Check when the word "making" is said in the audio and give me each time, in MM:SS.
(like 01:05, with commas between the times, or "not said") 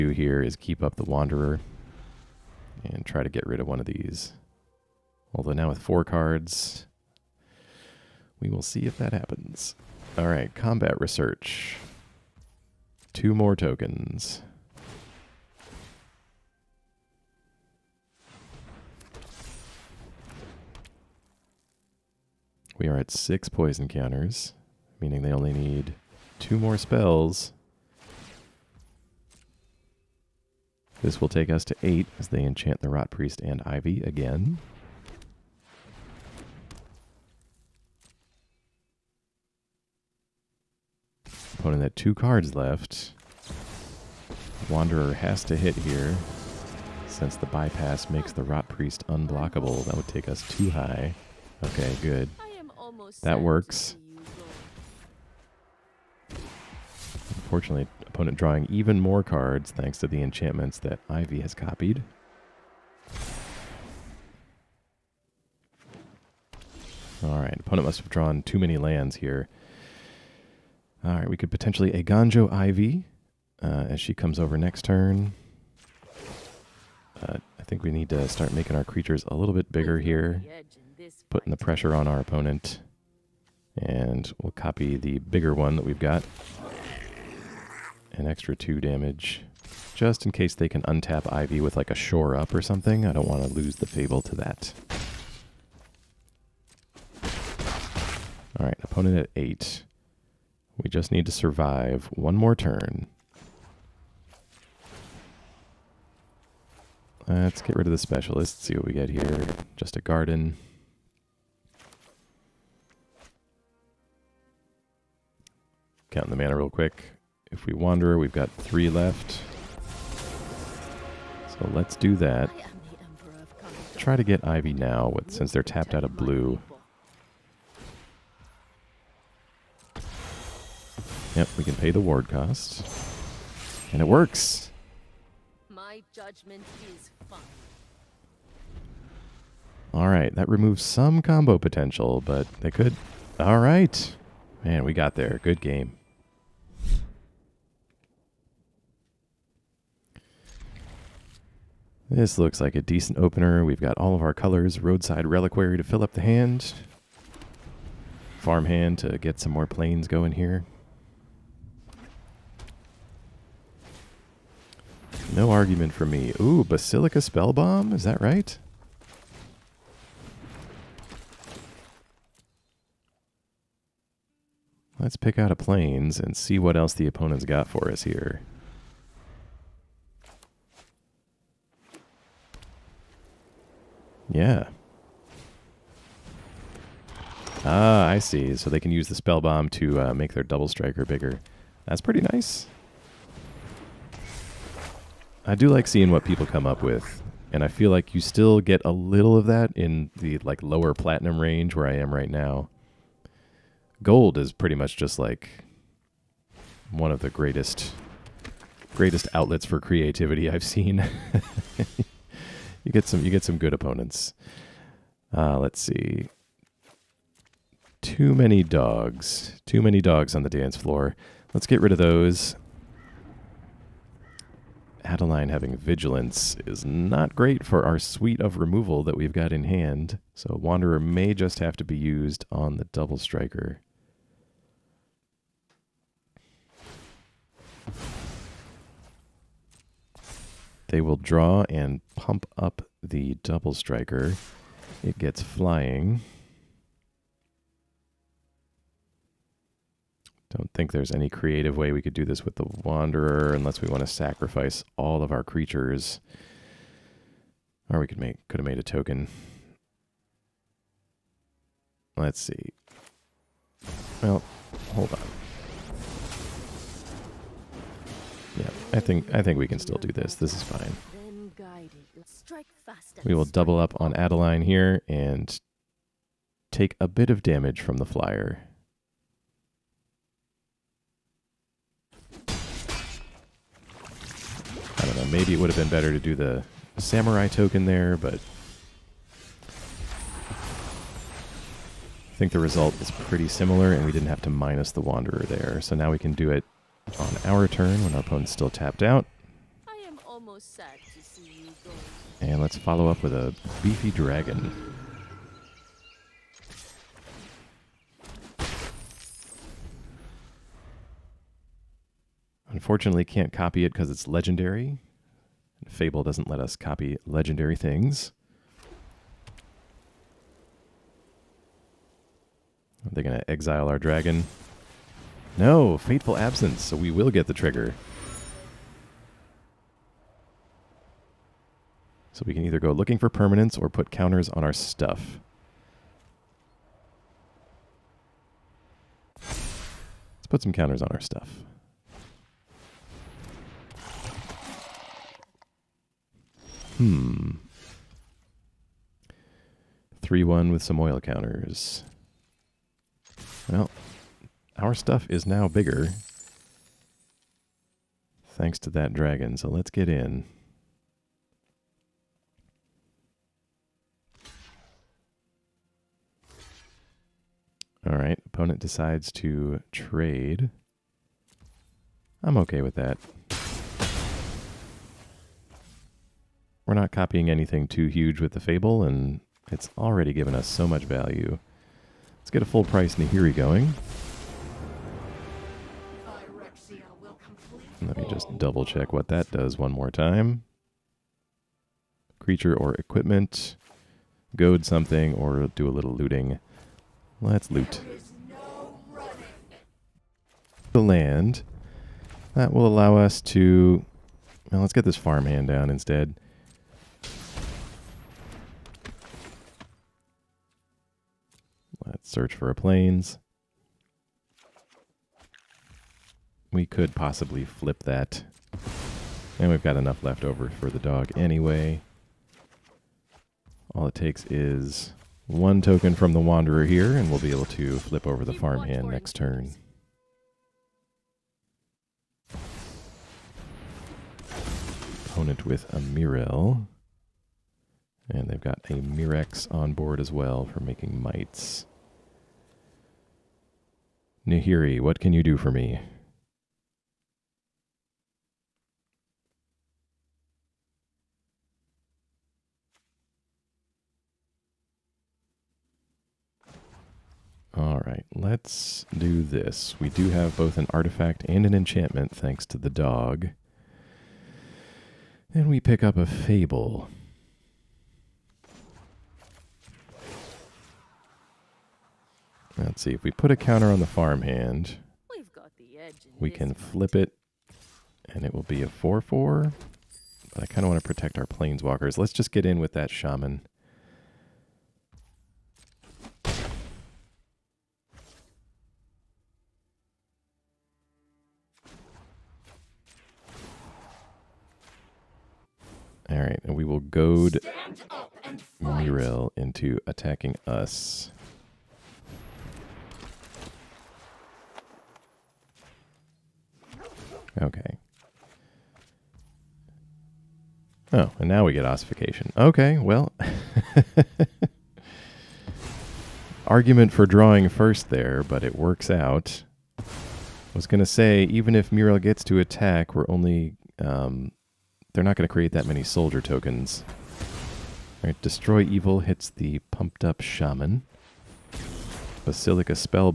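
01:18, 07:20.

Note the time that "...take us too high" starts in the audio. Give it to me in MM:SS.
00:50.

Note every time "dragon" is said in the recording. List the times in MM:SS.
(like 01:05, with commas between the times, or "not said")
05:04, 05:23, 05:59.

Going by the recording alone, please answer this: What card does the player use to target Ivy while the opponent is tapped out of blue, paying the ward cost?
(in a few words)
Eiganjo.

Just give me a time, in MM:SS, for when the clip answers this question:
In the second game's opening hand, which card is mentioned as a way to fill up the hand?
02:34.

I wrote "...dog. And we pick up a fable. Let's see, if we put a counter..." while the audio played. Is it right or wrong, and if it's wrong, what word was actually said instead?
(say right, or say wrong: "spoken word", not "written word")
right.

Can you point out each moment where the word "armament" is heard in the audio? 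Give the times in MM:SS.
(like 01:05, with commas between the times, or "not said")
not said.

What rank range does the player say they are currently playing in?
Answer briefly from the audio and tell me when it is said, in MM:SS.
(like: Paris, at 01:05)
lower platinum, at 03:20.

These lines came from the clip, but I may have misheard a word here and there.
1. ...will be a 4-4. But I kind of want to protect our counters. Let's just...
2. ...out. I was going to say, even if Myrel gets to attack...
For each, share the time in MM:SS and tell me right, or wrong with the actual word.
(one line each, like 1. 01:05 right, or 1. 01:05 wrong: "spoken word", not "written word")
1. 07:58 wrong: "planeswalkers", not "counters"
2. 08:39 right.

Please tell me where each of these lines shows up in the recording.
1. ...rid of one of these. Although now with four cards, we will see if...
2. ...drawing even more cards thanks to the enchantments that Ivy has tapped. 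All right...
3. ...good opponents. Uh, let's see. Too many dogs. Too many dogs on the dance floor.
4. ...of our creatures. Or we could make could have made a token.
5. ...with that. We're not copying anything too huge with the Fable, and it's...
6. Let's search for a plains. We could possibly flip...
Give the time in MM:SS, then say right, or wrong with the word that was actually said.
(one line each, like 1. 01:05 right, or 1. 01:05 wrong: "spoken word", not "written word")
1. 00:03 right
2. 00:58 wrong: "copied", not "tapped"
3. 03:33 right
4. 04:15 right
5. 06:12 right
6. 06:52 right.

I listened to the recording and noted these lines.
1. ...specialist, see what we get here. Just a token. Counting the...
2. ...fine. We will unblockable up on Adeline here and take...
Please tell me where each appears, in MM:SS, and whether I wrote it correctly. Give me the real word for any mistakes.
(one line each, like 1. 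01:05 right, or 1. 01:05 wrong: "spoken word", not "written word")
1. 01:47 wrong: "garden", not "token"
2. 04:30 wrong: "double", not "unblockable".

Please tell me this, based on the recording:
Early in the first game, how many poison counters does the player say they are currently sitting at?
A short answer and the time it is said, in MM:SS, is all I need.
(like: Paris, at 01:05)
6, at 00:23.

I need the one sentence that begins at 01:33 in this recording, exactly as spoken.
I don't want to lose the Fable to that.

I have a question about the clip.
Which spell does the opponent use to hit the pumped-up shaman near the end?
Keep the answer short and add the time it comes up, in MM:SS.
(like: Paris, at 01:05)
Destroy Evil, at 08:48.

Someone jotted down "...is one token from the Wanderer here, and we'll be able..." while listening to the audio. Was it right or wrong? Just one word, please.
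right.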